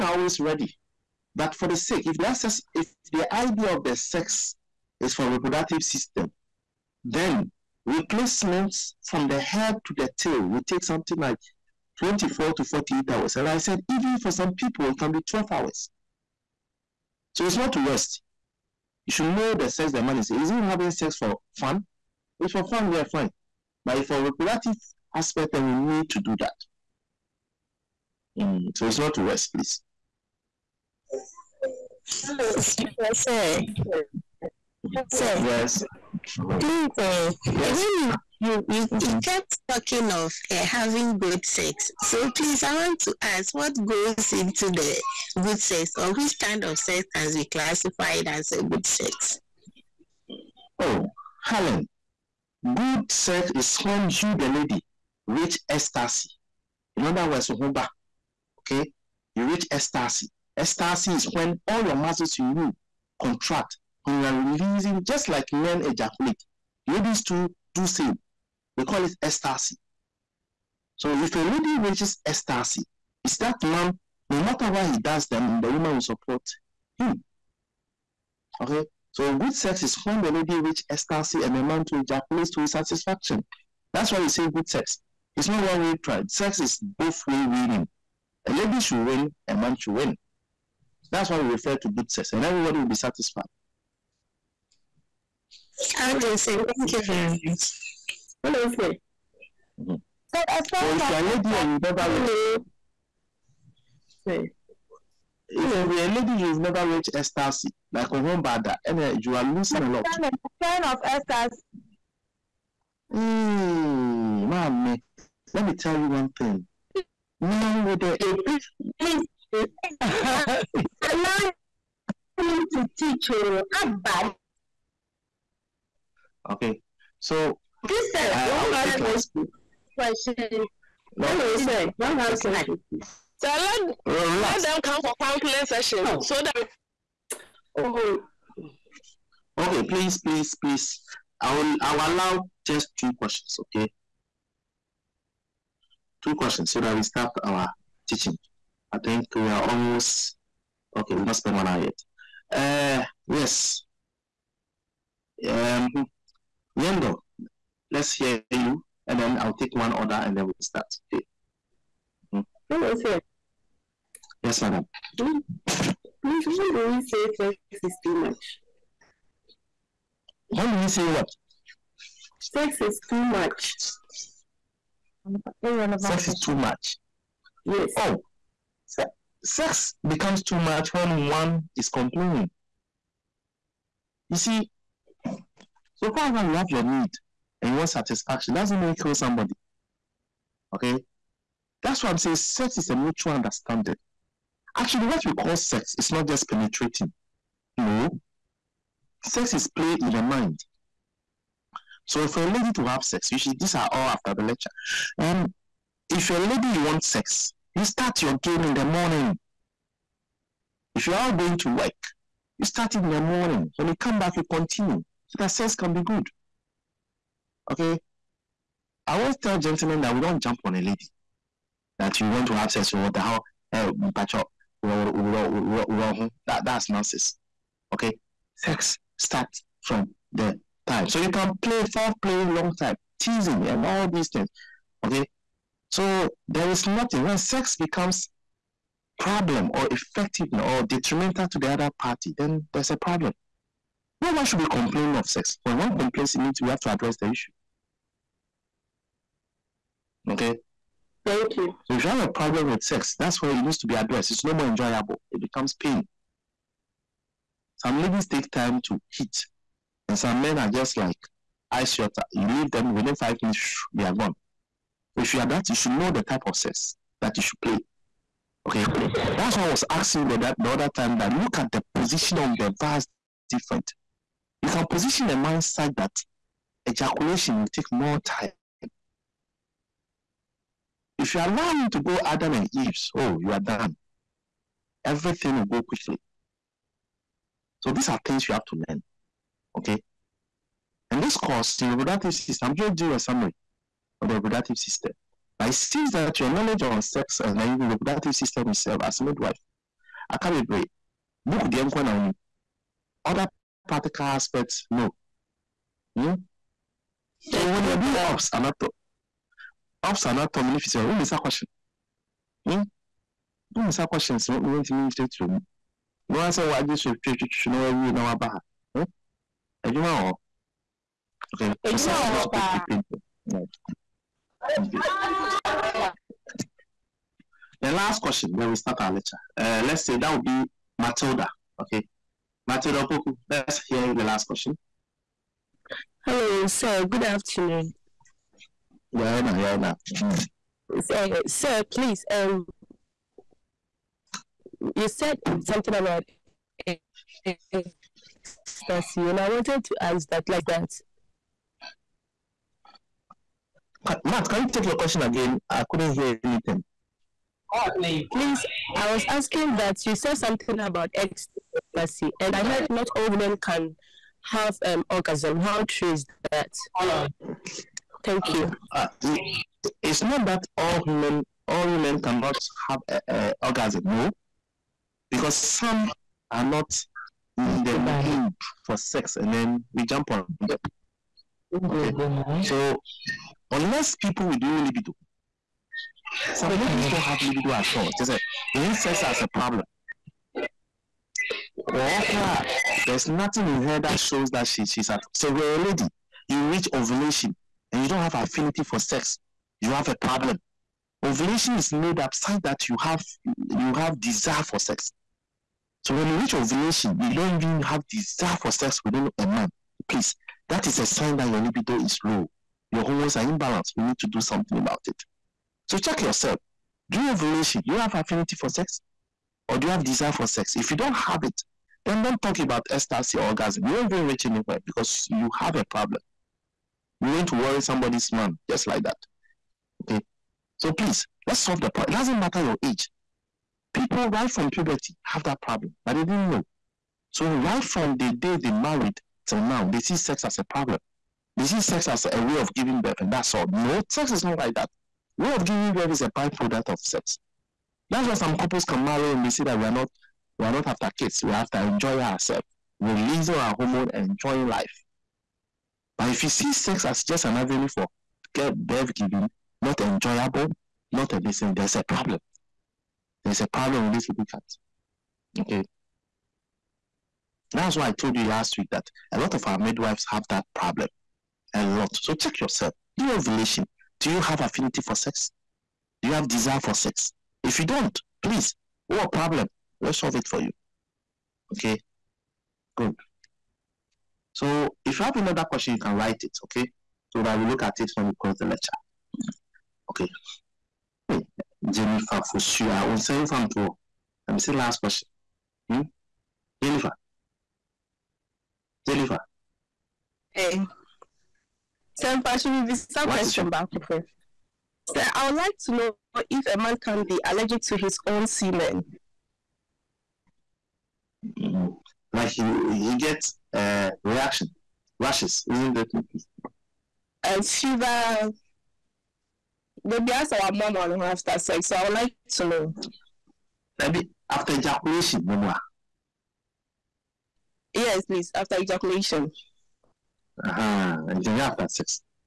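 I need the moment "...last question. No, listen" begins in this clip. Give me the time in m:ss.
2:08.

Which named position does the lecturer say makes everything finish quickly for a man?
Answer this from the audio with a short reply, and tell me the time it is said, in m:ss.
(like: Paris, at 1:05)
Adam and Eve, at 4:42.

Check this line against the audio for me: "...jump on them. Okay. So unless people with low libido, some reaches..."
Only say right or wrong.
wrong.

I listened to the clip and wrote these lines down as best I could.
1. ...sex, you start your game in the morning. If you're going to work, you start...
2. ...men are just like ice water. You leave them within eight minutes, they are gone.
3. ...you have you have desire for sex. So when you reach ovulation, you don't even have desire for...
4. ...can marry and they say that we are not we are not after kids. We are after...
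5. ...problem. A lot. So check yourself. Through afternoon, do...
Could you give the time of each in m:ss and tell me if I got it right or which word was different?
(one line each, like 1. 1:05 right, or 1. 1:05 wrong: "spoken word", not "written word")
1. 3:27 right
2. 4:20 wrong: "five", not "eight"
3. 6:42 right
4. 7:28 right
5. 7:50 wrong: "revelation", not "afternoon".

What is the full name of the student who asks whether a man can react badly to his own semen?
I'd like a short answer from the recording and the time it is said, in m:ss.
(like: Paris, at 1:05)
Jennifer Fushua, at 8:11.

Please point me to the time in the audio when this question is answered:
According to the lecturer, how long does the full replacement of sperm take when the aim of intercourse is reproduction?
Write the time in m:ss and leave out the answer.
0:11.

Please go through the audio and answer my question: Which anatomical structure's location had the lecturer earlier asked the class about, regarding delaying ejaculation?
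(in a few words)
Vas deferens.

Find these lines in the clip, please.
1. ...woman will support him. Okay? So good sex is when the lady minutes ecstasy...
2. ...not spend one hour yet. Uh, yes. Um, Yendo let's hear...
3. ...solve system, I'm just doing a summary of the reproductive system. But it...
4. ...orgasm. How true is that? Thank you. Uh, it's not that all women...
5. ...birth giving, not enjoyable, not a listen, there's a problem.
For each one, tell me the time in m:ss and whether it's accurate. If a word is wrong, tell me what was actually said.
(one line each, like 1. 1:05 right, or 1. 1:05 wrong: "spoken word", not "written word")
1. 1:15 wrong: "reaches", not "minutes"
2. 2:31 right
3. 4:51 wrong: "reproductive", not "solve"
4. 6:05 right
5. 7:38 right.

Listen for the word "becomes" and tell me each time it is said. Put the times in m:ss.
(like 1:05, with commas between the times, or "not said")
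3:00, 3:57, 4:15.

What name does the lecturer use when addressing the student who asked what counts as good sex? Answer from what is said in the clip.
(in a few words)
Helen.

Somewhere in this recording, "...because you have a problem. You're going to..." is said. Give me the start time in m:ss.
7:04.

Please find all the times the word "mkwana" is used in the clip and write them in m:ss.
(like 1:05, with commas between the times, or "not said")
5:01.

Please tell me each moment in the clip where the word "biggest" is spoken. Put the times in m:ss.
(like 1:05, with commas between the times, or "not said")
not said.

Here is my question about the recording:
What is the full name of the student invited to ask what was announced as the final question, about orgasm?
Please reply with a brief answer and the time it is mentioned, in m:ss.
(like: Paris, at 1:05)
Matilda Opoku, at 5:32.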